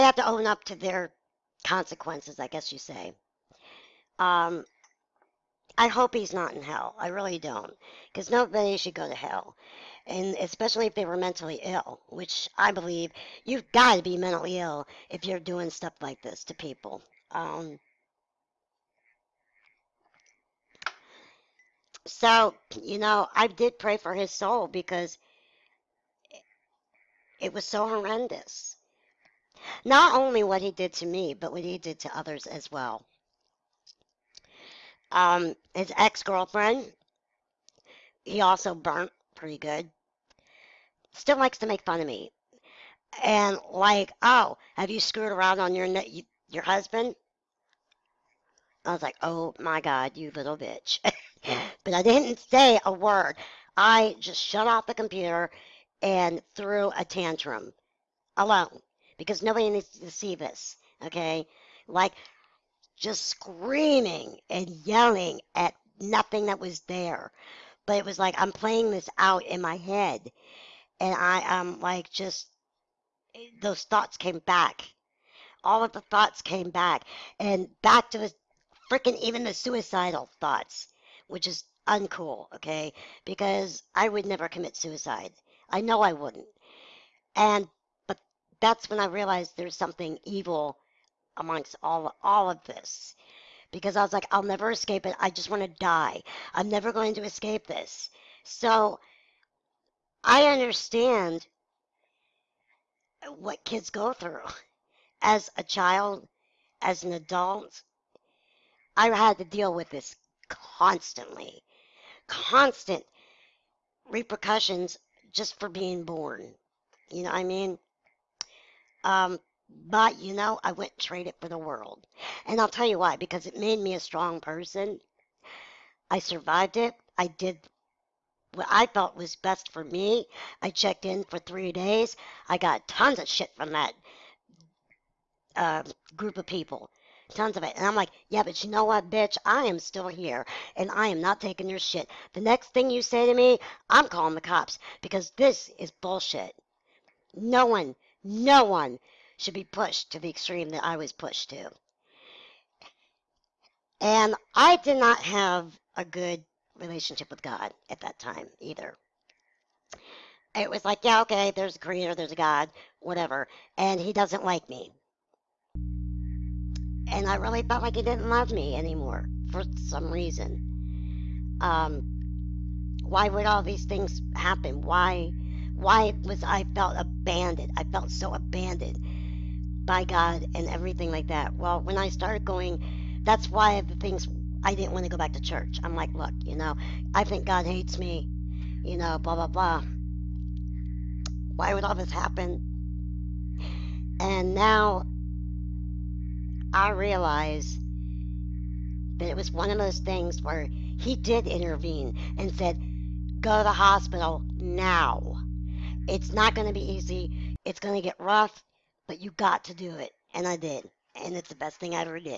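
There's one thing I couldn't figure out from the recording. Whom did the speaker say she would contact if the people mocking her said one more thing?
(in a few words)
The cops.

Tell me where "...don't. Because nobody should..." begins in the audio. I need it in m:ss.
0:07.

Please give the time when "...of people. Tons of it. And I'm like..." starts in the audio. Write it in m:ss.
2:16.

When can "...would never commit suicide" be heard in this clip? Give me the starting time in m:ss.
1:24.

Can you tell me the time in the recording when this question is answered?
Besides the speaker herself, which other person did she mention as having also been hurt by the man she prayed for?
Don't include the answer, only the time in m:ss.
0:35.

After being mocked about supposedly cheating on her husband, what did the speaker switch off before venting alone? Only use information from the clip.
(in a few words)
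The computer.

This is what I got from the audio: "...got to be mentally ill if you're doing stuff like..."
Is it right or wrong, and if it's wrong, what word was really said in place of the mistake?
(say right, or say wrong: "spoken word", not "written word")
right.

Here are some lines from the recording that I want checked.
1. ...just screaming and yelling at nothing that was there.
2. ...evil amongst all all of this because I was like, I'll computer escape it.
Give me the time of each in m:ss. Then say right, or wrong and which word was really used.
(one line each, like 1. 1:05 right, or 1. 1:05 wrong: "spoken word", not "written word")
1. 1:02 right
2. 1:30 wrong: "never", not "computer".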